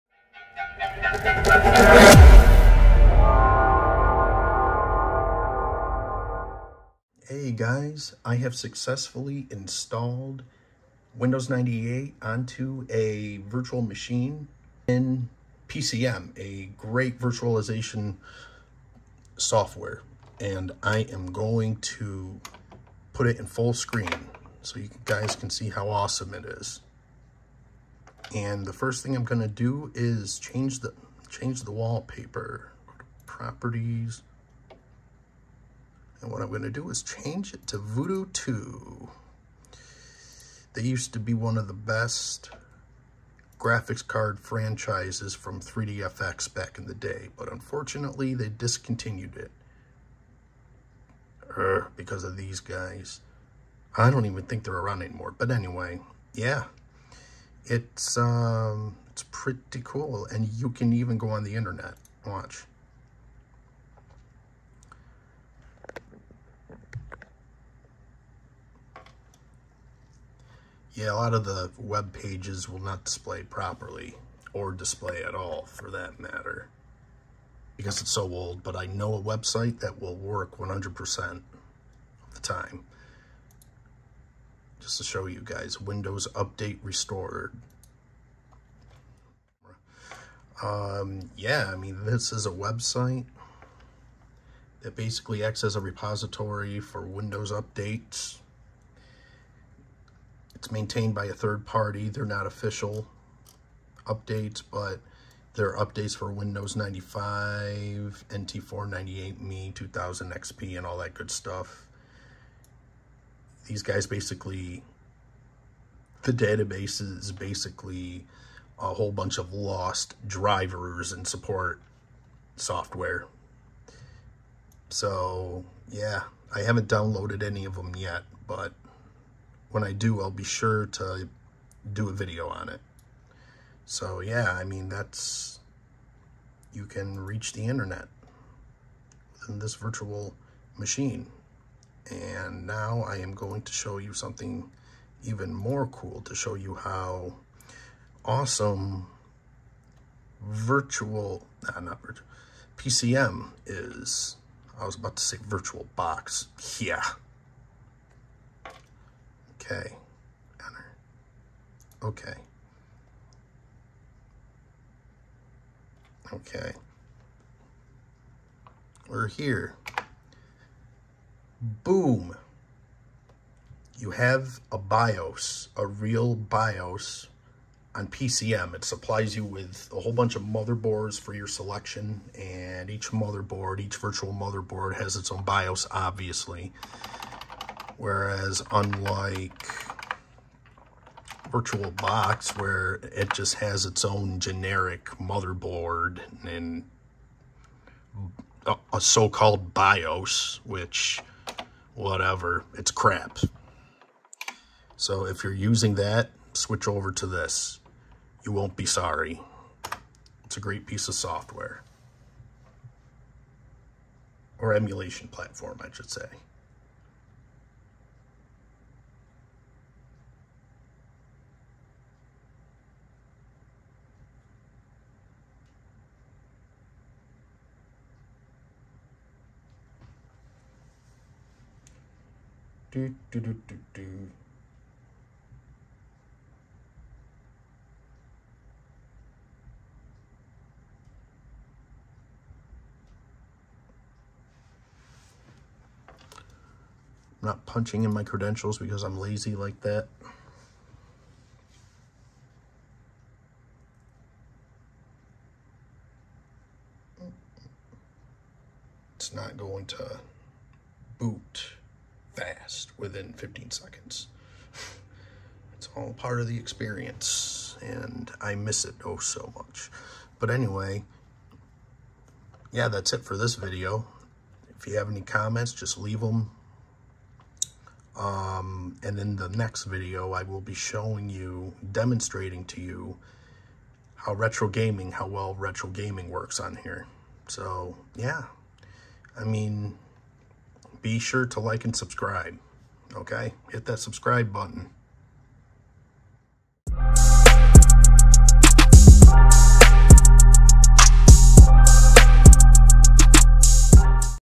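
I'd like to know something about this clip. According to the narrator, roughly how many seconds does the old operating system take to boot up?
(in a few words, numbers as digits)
15.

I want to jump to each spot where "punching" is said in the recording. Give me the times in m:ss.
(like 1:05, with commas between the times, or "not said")
4:07.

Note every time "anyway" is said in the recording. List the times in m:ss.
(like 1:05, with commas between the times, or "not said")
0:55, 4:30.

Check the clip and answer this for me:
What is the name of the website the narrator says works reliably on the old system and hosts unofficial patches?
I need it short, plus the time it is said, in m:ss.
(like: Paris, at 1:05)
Windows Update Restored, at 1:25.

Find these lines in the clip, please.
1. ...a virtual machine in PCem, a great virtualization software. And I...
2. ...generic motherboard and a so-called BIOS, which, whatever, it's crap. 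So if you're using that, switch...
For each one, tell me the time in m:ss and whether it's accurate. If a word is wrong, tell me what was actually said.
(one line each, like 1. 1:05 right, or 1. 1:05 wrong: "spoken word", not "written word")
1. 0:12 right
2. 3:14 right.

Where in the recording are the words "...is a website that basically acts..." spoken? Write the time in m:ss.
1:32.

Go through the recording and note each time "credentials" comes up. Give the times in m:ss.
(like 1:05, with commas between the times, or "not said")
4:08.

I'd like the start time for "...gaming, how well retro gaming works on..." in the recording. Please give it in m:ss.
4:44.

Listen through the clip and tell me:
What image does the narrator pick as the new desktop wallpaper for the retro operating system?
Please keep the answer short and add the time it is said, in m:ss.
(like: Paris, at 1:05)
Voodoo 2, at 0:37.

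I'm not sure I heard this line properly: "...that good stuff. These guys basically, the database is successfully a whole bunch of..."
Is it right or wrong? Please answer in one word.
wrong.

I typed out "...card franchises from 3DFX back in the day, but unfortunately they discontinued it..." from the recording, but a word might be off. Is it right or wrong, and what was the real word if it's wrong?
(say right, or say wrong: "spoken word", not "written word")
right.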